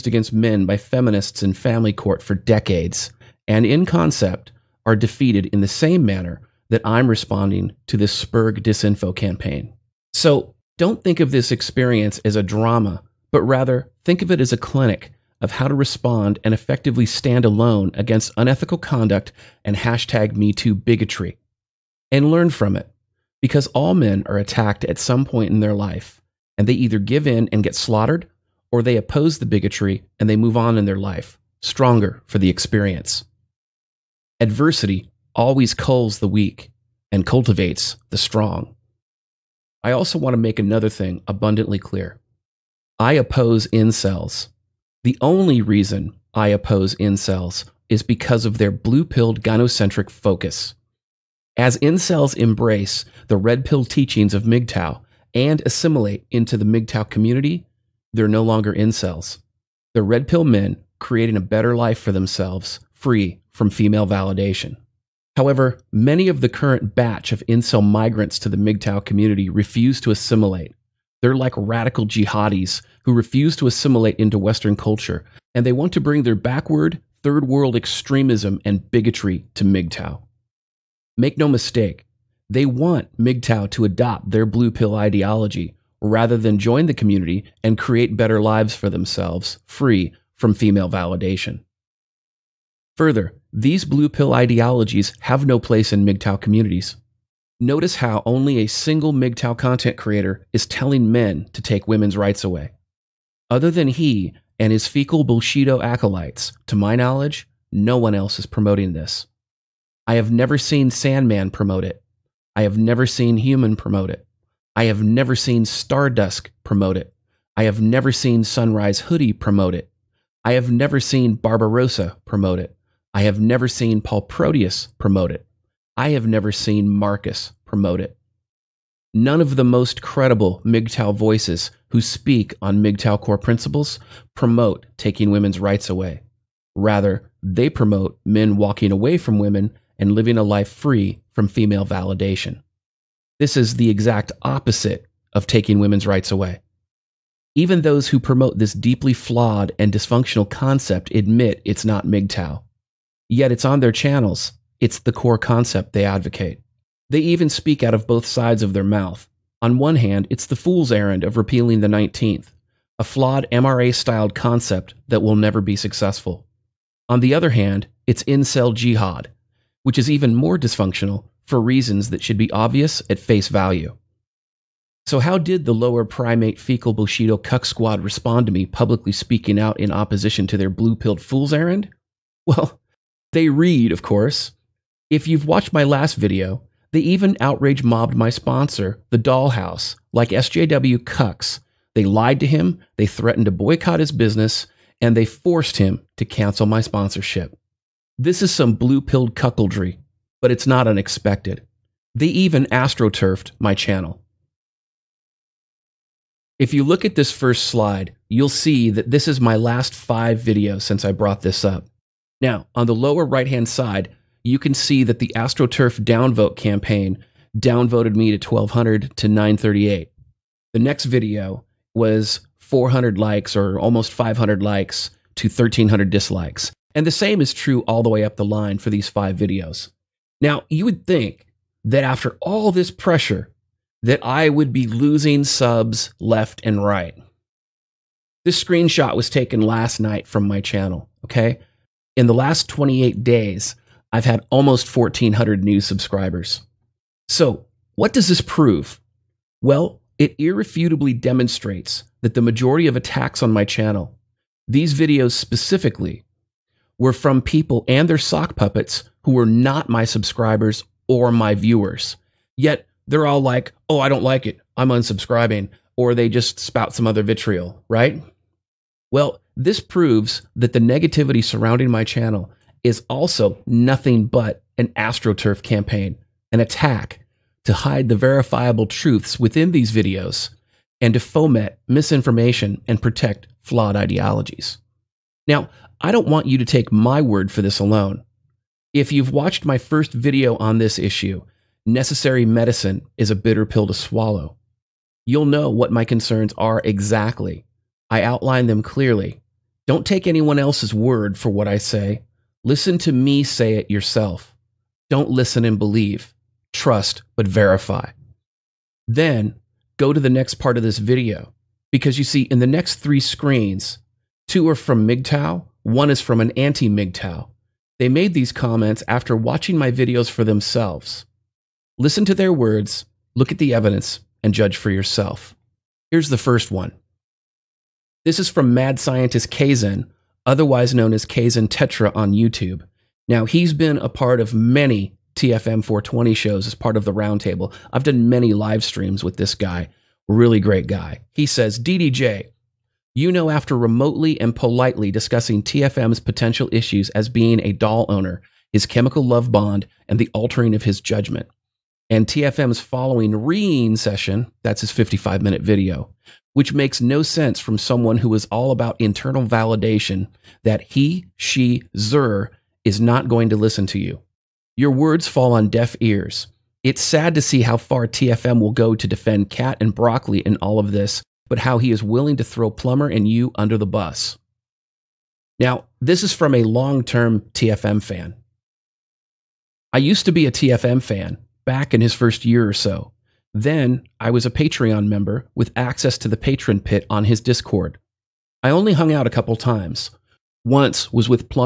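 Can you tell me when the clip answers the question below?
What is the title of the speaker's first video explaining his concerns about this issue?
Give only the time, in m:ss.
4:51.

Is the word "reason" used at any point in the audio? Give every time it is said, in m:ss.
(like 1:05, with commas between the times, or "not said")
0:45, 2:51.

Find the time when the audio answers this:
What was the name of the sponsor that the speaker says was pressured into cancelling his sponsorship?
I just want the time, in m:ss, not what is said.
3:09.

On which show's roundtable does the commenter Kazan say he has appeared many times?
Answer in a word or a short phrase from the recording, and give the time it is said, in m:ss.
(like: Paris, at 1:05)
TFM 420, at 5:35.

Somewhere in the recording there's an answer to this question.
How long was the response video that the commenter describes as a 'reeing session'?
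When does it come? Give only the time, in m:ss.
5:54.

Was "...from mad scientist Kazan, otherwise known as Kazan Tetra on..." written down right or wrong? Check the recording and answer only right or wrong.
right.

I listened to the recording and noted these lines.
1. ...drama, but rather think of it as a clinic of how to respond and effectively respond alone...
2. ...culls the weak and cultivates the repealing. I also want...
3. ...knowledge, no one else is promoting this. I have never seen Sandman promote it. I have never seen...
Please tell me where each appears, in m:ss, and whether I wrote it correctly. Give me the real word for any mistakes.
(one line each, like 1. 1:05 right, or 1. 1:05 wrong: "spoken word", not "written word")
1. 0:12 wrong: "stand", not "respond"
2. 0:35 wrong: "strong", not "repealing"
3. 1:46 right.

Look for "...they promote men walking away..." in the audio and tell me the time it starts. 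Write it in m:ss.
2:17.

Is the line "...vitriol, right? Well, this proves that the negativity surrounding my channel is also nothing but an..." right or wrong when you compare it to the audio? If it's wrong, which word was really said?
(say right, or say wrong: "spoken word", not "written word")
right.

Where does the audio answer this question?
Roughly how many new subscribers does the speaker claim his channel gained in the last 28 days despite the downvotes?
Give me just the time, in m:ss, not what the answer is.
4:04.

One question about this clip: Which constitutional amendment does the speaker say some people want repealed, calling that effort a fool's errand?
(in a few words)
19th.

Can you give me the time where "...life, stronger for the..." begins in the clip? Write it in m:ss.
0:30.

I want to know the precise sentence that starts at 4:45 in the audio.
Now, I don't want you to take my word for this alone.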